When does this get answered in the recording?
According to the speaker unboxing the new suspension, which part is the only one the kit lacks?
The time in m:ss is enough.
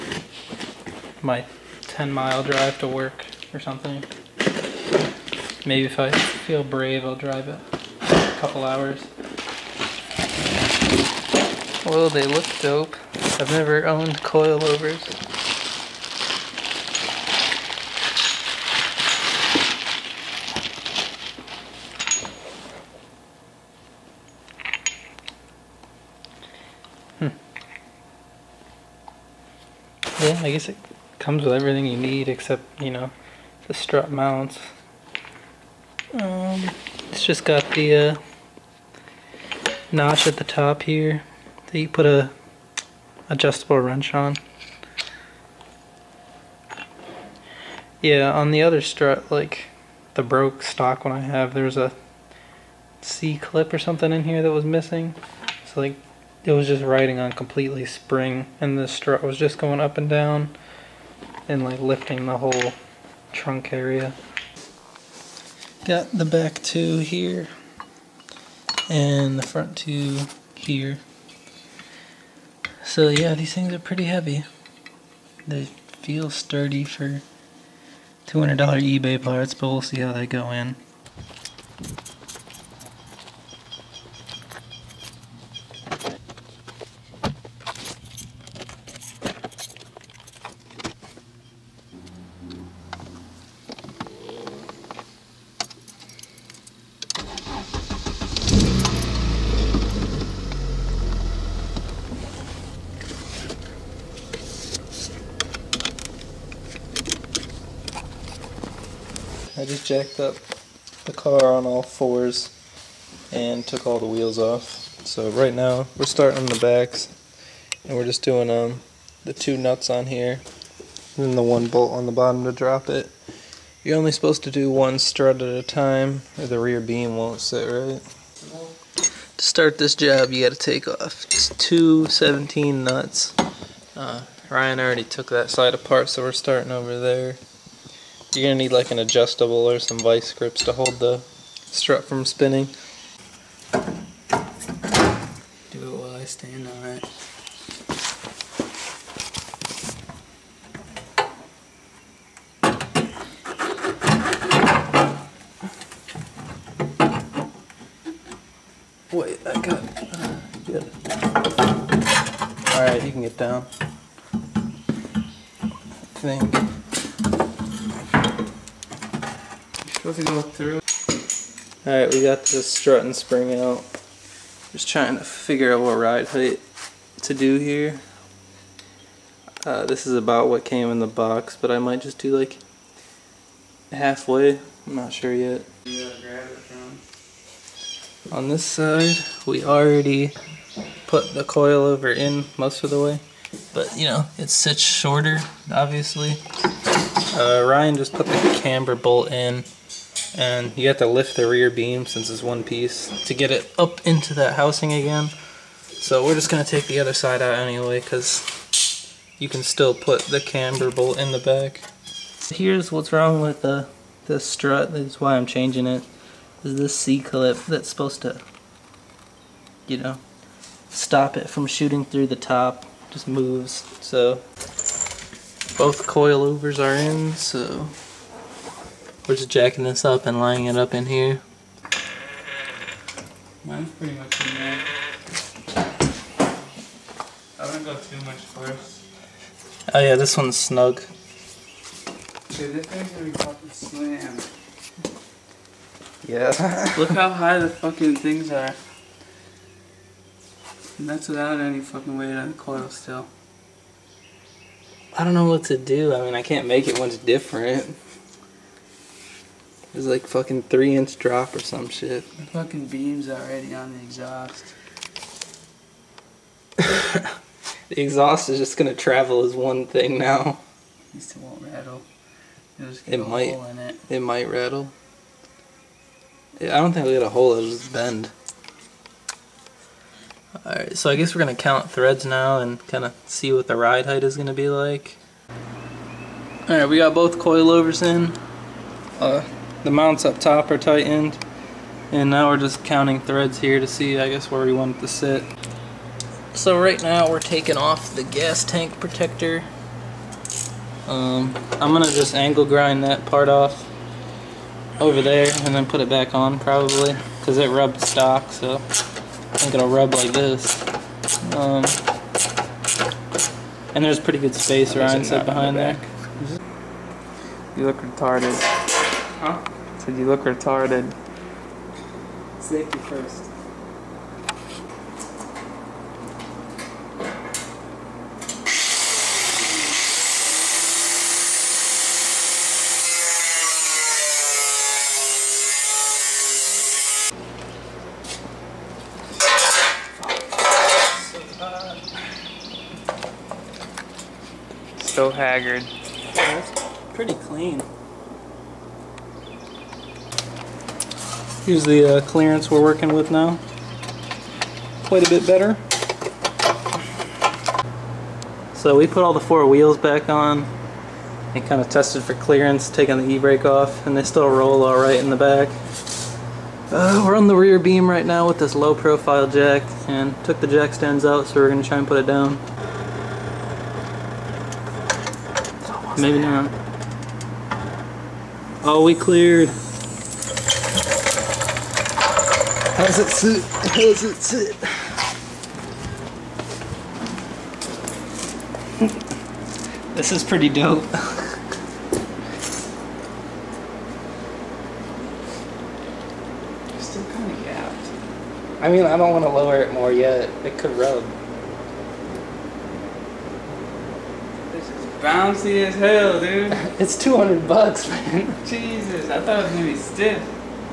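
0:33.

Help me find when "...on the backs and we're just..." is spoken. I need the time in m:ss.
1:56.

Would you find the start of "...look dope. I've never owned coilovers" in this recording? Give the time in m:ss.
0:12.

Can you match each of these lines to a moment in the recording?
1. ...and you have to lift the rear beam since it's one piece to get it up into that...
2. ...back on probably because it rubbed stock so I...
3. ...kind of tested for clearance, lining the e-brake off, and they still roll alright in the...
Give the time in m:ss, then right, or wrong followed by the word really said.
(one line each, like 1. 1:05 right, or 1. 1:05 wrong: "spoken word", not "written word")
1. 3:20 right
2. 5:06 right
3. 6:01 wrong: "taking", not "lining".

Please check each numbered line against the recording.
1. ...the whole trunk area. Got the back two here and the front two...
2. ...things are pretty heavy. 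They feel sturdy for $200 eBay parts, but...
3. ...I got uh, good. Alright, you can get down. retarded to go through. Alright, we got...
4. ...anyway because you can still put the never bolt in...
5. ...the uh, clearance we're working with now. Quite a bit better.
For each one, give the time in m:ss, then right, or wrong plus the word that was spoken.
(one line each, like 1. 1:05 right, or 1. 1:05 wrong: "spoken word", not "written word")
1. 1:02 right
2. 1:13 right
3. 2:39 wrong: "supposed", not "retarded"
4. 3:27 wrong: "camber", not "never"
5. 5:51 right.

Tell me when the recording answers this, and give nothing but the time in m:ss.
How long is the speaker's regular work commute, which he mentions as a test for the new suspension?
0:01.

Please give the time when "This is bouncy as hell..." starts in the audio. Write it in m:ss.
6:44.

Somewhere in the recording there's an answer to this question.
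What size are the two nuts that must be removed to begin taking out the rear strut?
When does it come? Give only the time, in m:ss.
2:12.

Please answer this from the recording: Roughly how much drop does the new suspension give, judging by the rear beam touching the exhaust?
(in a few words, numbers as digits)
3 inches.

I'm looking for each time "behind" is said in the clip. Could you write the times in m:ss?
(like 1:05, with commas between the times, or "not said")
5:15.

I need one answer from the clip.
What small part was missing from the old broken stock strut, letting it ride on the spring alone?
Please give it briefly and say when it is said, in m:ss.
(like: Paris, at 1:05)
C clip, at 0:53.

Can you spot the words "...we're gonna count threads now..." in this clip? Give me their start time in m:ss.
4:41.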